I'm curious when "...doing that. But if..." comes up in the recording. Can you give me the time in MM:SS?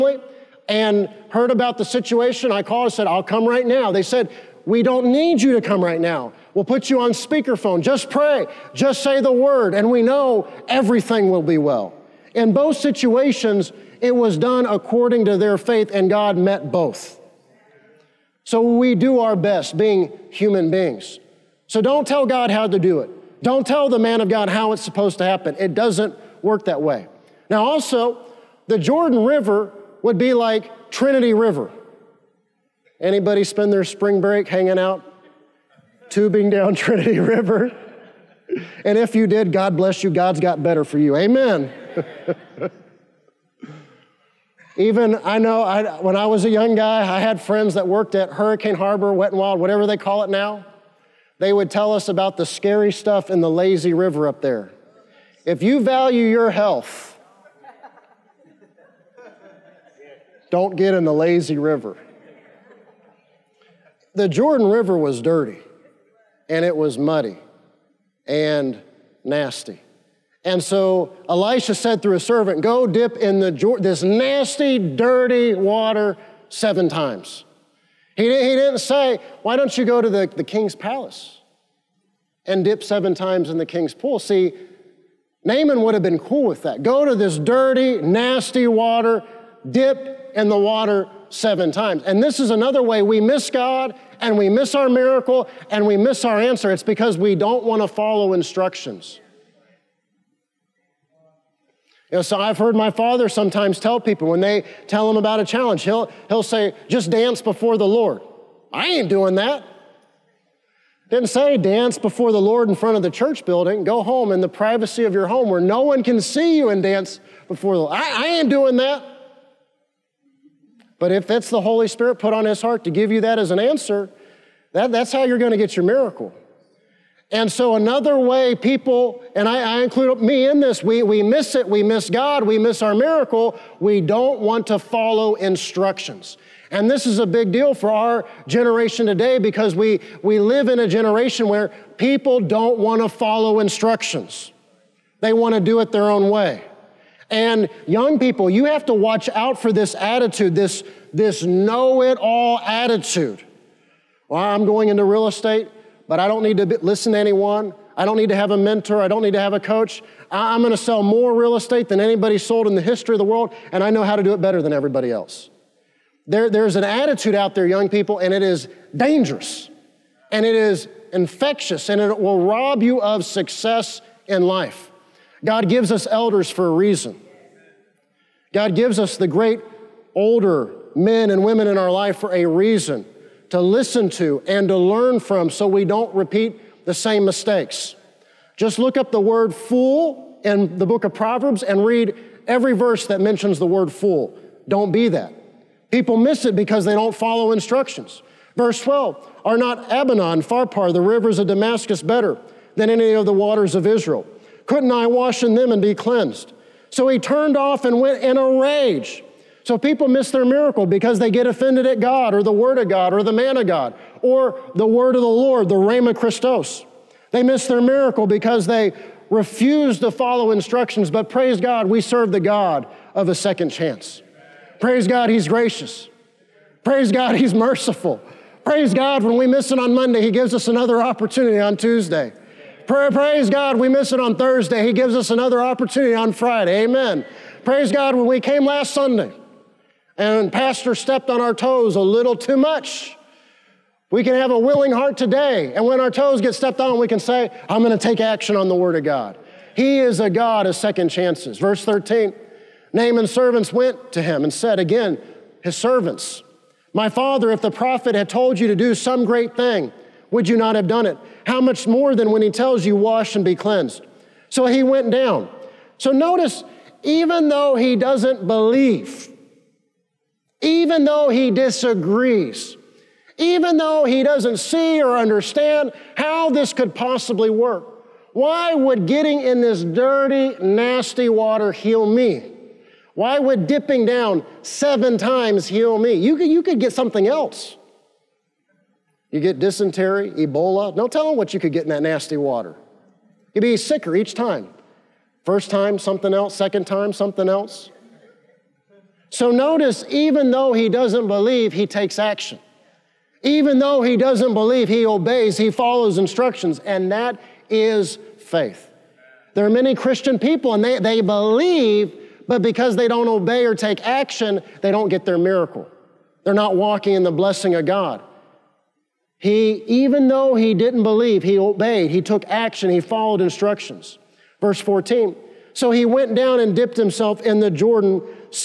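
01:58.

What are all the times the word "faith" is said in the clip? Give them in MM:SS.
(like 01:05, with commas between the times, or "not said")
00:15, 05:08.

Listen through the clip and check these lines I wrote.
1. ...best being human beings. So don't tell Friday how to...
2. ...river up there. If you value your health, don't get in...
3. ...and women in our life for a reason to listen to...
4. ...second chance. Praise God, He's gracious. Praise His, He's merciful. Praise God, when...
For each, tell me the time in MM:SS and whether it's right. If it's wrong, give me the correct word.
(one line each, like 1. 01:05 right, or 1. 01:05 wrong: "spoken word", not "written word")
1. 00:19 wrong: "God", not "Friday"
2. 00:53 right
3. 03:01 right
4. 03:43 wrong: "God", not "His".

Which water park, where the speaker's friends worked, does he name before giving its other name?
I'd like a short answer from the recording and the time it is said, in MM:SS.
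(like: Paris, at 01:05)
Hurricane Harbor, at 00:48.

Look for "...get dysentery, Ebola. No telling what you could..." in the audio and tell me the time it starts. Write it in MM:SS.
04:49.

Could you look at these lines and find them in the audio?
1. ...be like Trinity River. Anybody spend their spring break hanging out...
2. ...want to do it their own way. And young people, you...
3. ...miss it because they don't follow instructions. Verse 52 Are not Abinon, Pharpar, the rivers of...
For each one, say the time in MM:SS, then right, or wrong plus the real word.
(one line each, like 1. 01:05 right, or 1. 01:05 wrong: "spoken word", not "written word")
1. 00:30 right
2. 02:25 right
3. 03:16 wrong: "12", not "52".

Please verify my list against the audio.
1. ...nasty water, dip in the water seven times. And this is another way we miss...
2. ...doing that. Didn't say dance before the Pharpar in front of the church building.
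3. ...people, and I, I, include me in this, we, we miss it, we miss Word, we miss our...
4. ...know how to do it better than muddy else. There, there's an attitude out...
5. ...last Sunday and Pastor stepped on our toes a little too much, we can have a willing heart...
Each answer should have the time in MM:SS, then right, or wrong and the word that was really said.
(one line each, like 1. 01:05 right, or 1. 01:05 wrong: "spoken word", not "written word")
1. 01:28 right
2. 01:49 wrong: "Lord", not "Pharpar"
3. 02:08 wrong: "God", not "Word"
4. 02:43 wrong: "everybody", not "muddy"
5. 03:58 right.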